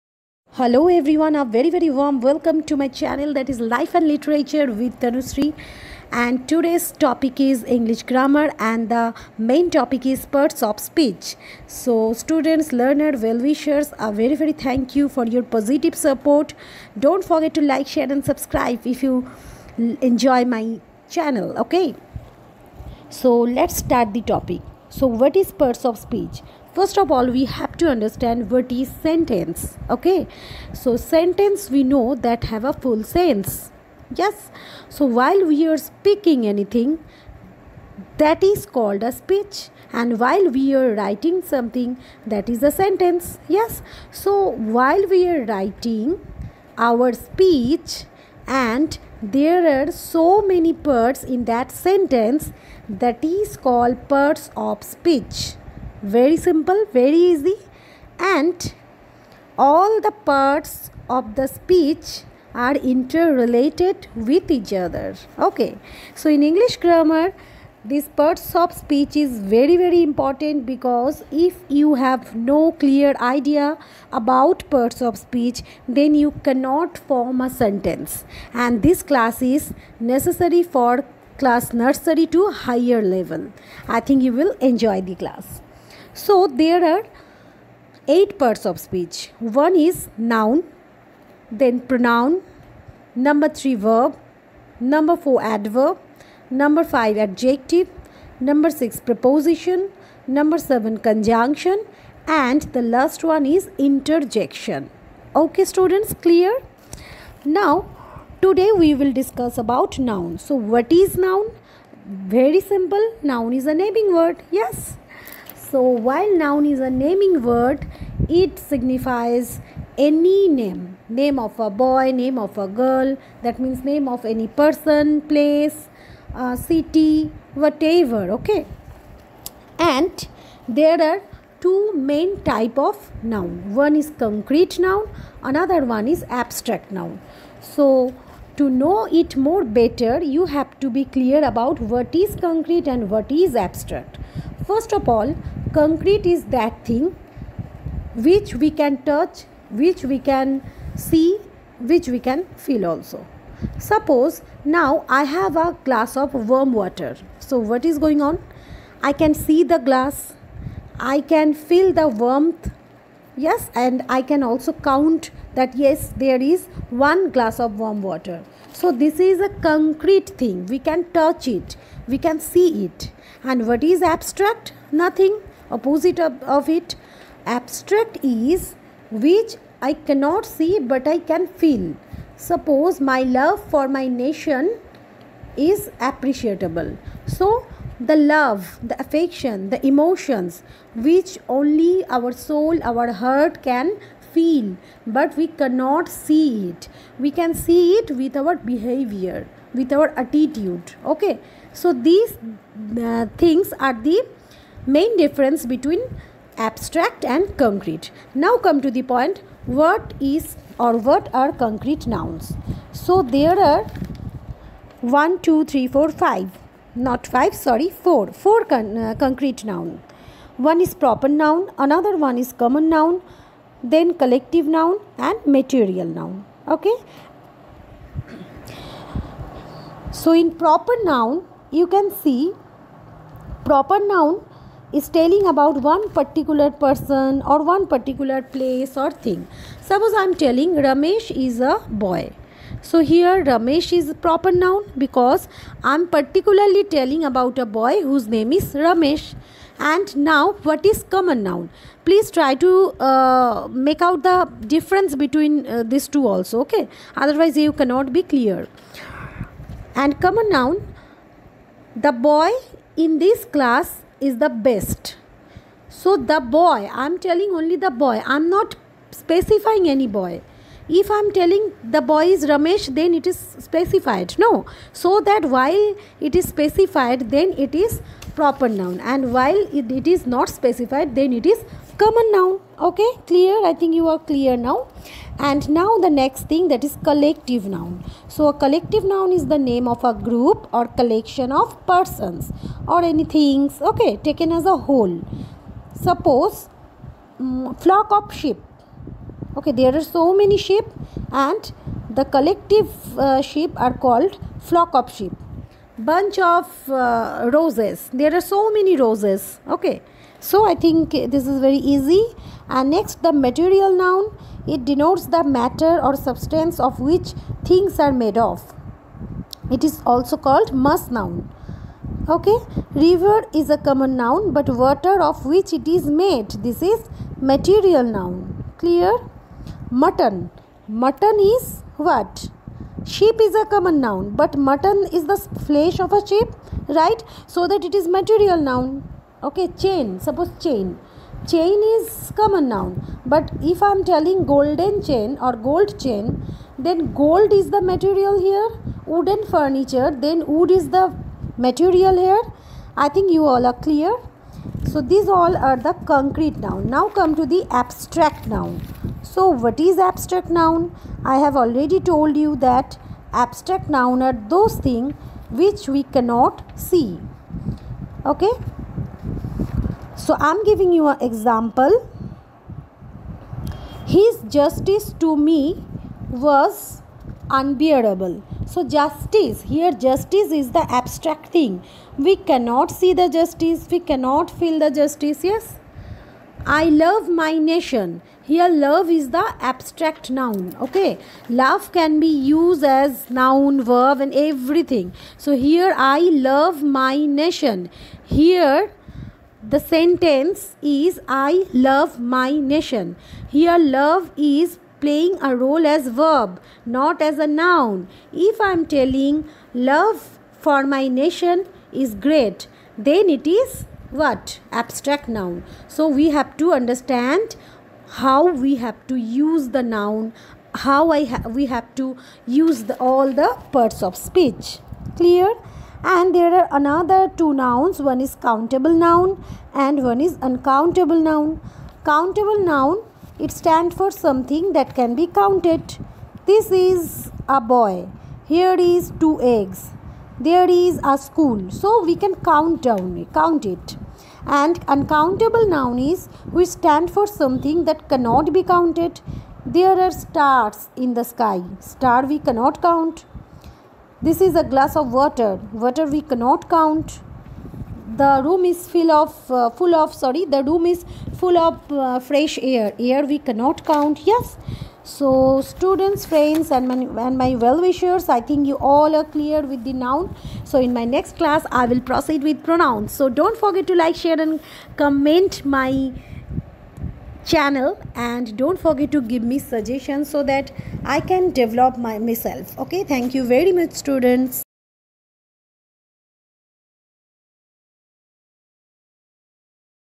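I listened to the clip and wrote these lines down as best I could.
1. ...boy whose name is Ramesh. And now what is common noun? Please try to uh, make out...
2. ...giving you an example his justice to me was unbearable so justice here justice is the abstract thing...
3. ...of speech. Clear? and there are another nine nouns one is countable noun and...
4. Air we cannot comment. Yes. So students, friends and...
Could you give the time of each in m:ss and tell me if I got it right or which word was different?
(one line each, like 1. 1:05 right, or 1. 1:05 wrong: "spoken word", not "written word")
1. 4:07 right
2. 6:10 right
3. 7:04 wrong: "two", not "nine"
4. 7:42 wrong: "count", not "comment".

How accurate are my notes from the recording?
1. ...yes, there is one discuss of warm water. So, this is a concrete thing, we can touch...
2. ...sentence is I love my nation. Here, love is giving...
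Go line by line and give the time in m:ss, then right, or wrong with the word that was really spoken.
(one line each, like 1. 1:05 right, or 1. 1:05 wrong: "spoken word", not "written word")
1. 2:45 wrong: "glass", not "discuss"
2. 6:39 wrong: "playing", not "giving".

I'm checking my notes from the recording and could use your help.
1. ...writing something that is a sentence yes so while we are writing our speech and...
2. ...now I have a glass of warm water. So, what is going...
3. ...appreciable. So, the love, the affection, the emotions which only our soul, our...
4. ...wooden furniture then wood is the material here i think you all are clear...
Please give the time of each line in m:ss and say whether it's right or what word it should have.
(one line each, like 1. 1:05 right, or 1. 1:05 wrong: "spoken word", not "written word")
1. 0:40 right
2. 2:34 right
3. 3:05 right
4. 5:49 right.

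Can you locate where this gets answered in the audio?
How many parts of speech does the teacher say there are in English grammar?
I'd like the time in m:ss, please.
1:28.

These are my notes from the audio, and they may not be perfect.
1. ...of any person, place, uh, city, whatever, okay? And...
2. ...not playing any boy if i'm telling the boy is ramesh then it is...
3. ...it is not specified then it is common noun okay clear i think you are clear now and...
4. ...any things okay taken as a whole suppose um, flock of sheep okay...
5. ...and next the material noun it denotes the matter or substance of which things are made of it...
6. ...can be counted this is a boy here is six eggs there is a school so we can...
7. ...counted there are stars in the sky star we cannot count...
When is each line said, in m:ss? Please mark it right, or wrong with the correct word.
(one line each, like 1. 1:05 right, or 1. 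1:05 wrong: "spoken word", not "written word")
1. 2:04 right
2. 4:28 wrong: "specifying", not "playing"
3. 4:39 right
4. 4:53 right
5. 5:12 right
6. 7:14 wrong: "two", not "six"
7. 7:28 right.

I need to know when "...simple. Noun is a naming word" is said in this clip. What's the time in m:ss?
1:52.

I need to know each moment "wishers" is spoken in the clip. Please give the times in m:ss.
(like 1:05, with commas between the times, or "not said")
0:13, 7:47.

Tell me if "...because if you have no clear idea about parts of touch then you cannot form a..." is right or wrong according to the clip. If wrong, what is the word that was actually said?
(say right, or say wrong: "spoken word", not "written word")
wrong: "speech", not "touch".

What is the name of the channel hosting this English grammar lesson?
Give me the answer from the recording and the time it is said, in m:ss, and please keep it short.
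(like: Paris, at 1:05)
Life and Literature with Tanushree, at 0:03.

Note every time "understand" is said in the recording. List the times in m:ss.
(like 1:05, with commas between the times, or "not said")
0:27, 6:56.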